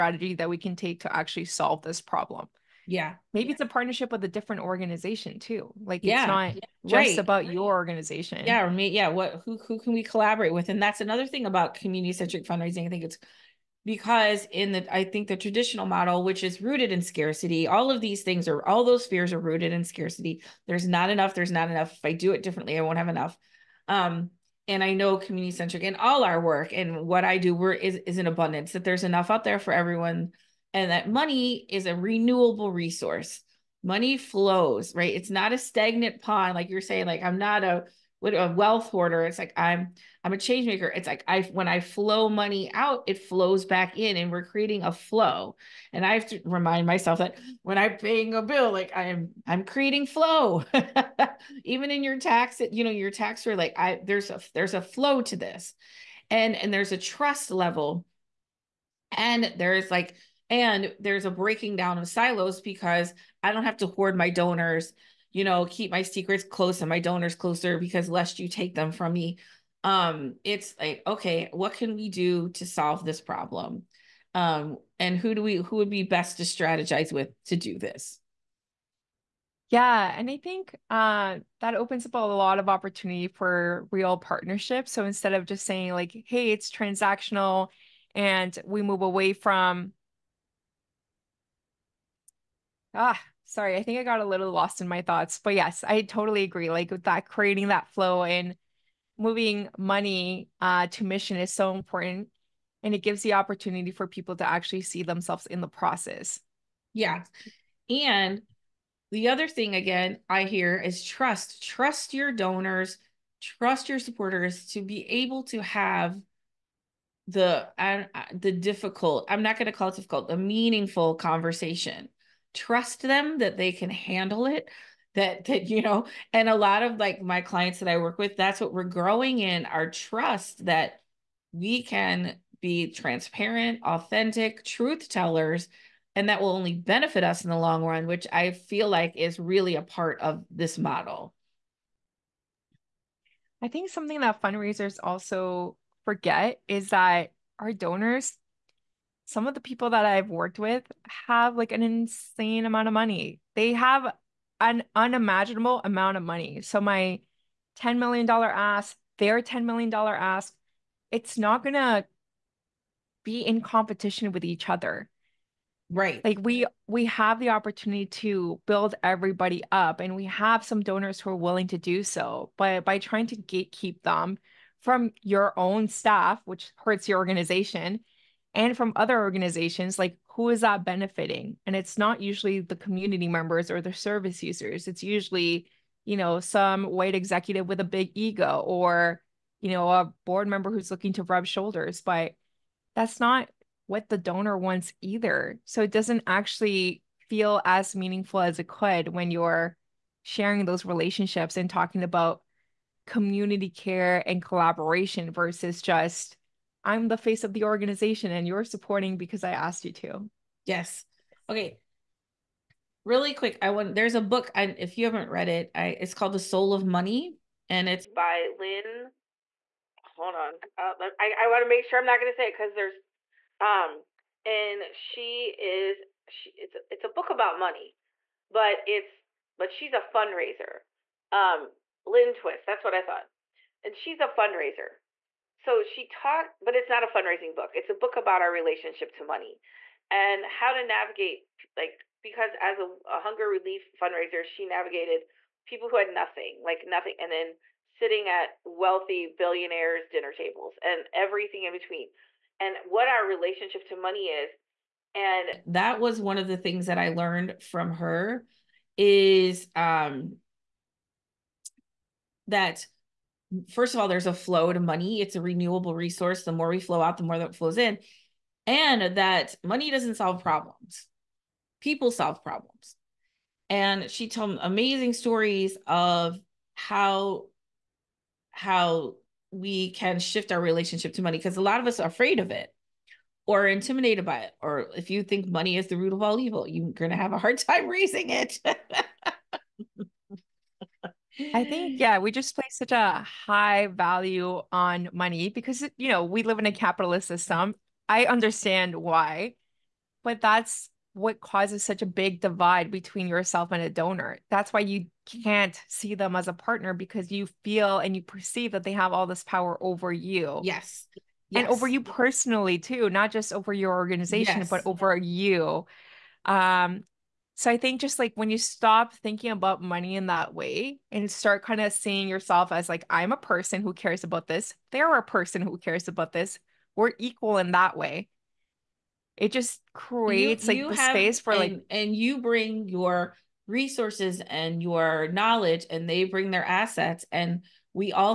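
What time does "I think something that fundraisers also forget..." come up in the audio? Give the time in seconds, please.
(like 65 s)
143 s.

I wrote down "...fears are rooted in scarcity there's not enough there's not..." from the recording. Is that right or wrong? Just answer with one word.
right.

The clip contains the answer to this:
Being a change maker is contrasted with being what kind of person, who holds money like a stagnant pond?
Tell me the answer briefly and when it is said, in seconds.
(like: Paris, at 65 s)
wealth hoarder, at 38 s.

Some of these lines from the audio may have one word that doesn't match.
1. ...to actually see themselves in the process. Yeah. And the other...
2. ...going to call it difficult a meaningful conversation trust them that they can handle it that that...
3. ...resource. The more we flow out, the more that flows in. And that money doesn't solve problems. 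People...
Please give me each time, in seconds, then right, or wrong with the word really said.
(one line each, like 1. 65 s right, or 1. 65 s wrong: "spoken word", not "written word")
1. 104 s right
2. 119 s right
3. 265 s right.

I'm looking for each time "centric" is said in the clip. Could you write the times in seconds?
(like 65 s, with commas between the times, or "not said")
12 s, 25 s.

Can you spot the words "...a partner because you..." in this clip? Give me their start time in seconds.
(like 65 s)
306 s.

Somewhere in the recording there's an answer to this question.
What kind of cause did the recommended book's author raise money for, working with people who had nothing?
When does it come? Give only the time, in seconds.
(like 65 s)
243 s.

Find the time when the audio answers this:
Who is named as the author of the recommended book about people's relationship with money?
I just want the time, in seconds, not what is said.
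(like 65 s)
232 s.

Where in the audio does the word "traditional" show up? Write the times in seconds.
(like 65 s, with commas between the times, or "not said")
15 s.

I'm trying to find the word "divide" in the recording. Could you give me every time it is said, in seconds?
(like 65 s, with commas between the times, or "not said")
302 s.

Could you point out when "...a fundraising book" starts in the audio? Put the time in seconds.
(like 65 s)
237 s.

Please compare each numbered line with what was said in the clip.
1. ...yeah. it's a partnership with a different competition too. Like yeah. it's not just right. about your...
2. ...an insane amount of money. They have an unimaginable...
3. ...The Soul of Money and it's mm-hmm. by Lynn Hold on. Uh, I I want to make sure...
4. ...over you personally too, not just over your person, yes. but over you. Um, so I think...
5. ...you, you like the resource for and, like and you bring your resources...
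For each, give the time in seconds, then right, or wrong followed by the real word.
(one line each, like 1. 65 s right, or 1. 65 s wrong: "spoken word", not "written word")
1. 3 s wrong: "organization", not "competition"
2. 151 s right
3. 216 s right
4. 311 s wrong: "organization", not "person"
5. 330 s wrong: "space", not "resource".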